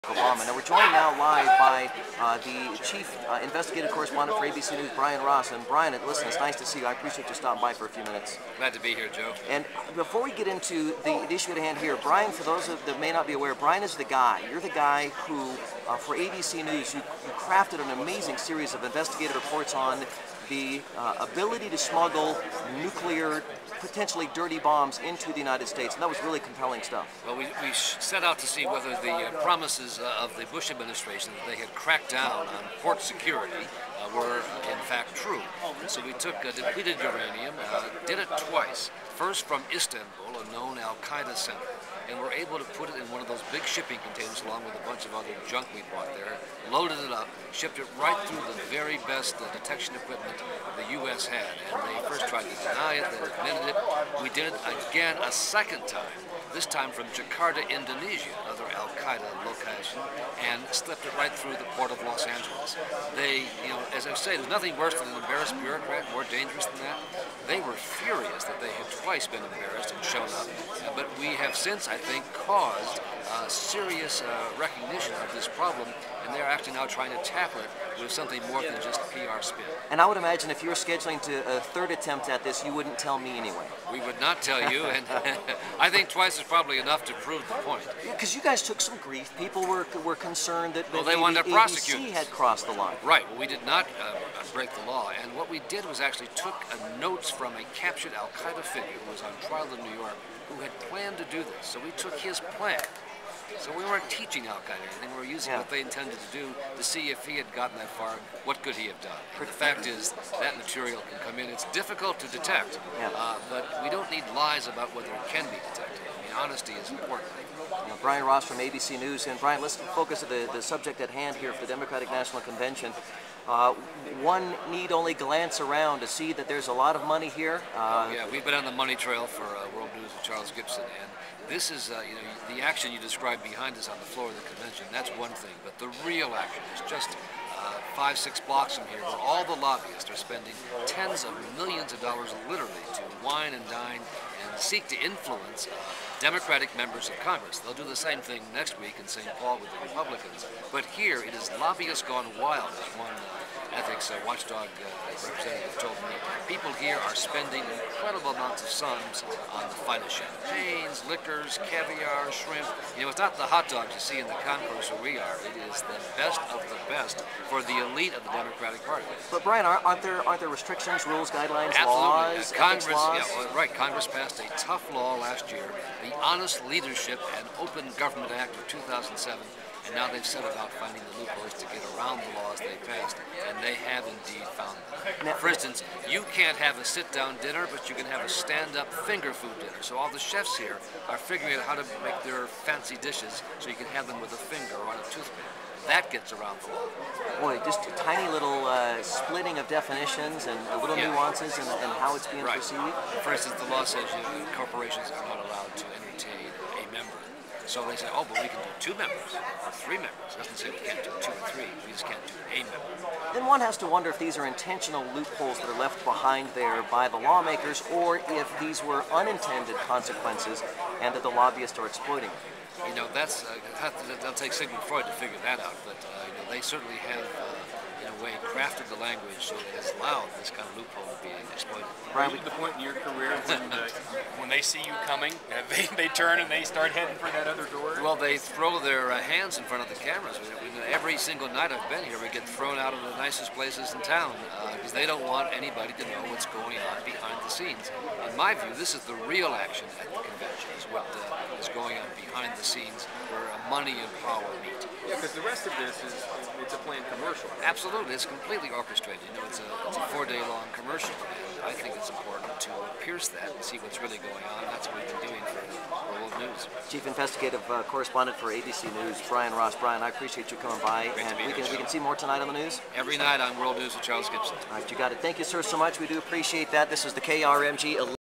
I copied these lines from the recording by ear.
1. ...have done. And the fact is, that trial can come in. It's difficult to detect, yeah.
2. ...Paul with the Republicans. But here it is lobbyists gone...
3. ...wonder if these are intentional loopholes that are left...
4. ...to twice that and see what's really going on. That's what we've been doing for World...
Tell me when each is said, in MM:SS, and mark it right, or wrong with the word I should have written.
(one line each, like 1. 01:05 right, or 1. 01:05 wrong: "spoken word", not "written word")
1. 01:48 wrong: "material", not "trial"
2. 02:29 right
3. 03:33 right
4. 04:22 wrong: "pierce", not "twice".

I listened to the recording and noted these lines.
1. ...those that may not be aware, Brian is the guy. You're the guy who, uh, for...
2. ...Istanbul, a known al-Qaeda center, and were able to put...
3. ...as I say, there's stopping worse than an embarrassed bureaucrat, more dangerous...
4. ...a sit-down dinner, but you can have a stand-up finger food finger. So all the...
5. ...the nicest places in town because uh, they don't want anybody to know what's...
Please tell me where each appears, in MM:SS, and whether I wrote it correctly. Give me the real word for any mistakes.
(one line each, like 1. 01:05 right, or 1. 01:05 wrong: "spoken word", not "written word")
1. 00:12 right
2. 00:39 right
3. 01:03 wrong: "nothing", not "stopping"
4. 03:06 wrong: "dinner", not "finger"
5. 04:03 right.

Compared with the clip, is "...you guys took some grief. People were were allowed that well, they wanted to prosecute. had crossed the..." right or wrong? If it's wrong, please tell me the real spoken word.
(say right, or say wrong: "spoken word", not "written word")
wrong: "concerned", not "allowed".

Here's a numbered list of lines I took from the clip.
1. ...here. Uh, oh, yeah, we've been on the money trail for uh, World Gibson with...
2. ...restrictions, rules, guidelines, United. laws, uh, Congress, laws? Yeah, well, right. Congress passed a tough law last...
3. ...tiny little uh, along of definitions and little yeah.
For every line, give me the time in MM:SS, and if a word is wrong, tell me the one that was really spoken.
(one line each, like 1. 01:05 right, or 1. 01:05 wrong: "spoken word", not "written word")
1. 02:07 wrong: "News", not "Gibson"
2. 02:50 wrong: "Absolutely", not "United"
3. 03:17 wrong: "splitting", not "along".